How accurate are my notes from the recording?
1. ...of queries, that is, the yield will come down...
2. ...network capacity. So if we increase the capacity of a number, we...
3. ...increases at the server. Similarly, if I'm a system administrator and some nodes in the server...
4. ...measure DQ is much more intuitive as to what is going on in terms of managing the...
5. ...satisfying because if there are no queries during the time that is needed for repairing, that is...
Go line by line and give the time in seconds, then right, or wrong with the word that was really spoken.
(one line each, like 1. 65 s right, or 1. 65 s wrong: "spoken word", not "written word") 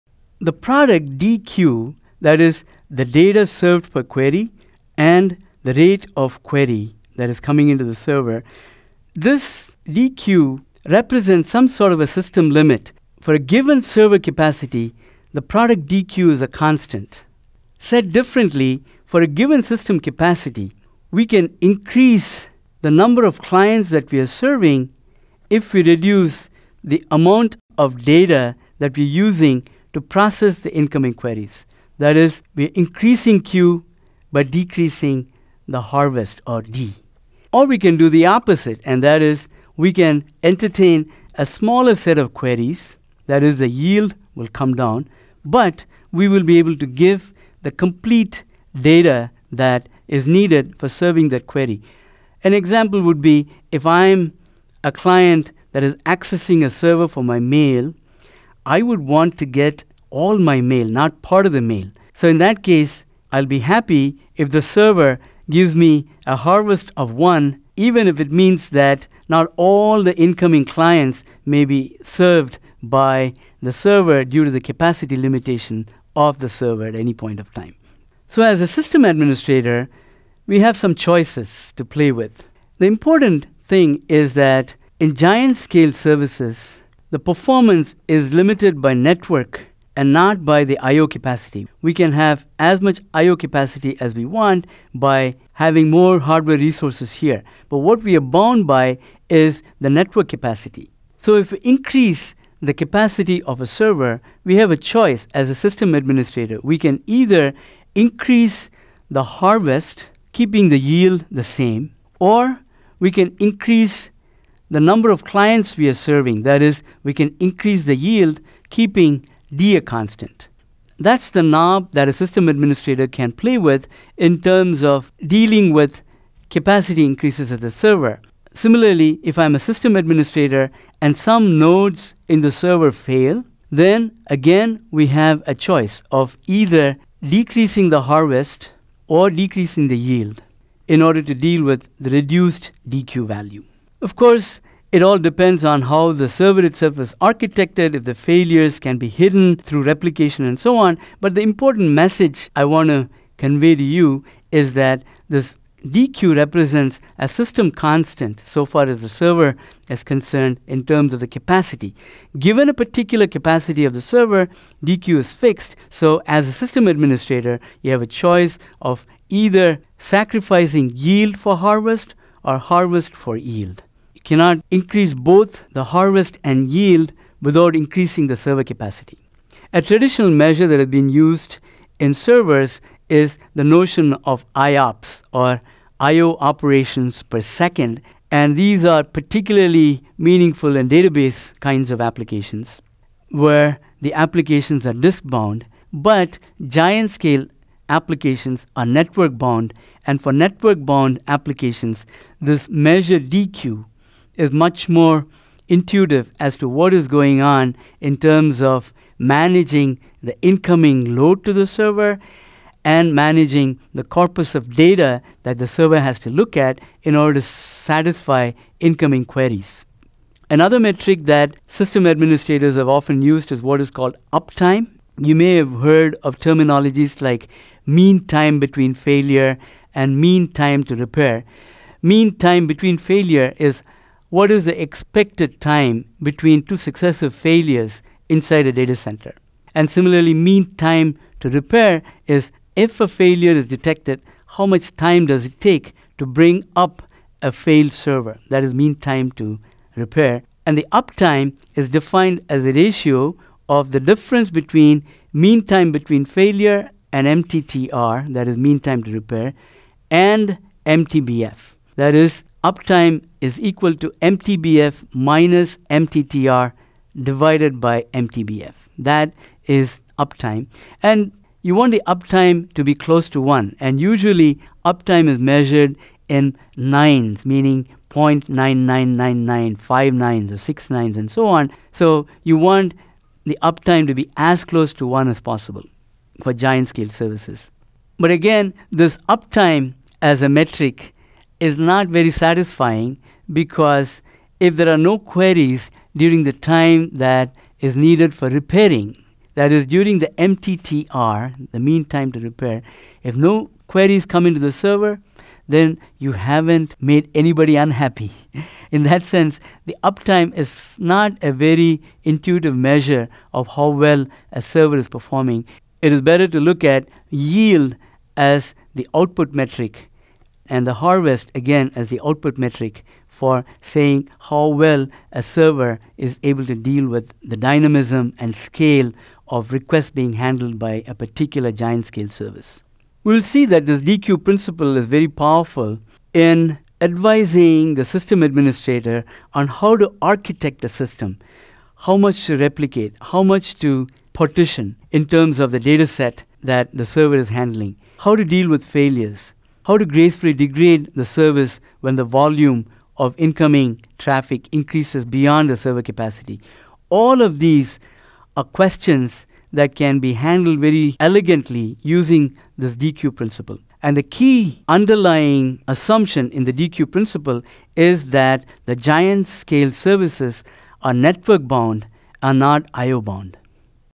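1. 42 s right
2. 99 s wrong: "server", not "number"
3. 127 s right
4. 202 s right
5. 292 s right.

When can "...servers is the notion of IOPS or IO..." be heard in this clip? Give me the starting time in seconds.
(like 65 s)
182 s.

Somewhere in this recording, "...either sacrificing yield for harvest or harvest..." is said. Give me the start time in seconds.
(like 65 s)
169 s.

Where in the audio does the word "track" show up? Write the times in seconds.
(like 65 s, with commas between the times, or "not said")
not said.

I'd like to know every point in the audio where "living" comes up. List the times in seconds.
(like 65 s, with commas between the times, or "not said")
not said.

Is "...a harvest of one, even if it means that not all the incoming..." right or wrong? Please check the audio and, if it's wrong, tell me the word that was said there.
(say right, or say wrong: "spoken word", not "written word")
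right.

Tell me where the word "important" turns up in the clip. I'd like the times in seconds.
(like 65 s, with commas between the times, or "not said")
82 s, 151 s.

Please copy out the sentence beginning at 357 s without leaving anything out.
All of these are questions that can be handled very elegantly using this DQ principle.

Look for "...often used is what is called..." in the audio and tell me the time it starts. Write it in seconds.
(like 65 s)
222 s.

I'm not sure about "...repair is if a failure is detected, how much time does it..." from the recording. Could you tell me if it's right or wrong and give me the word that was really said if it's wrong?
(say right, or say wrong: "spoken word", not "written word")
right.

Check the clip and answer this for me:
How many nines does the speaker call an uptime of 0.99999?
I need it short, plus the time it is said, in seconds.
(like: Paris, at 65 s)
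5 nines, at 279 s.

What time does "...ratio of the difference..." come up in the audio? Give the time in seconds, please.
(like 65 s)
252 s.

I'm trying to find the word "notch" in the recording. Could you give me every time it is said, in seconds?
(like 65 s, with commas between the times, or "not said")
not said.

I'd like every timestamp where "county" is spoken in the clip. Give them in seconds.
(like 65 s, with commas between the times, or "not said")
not said.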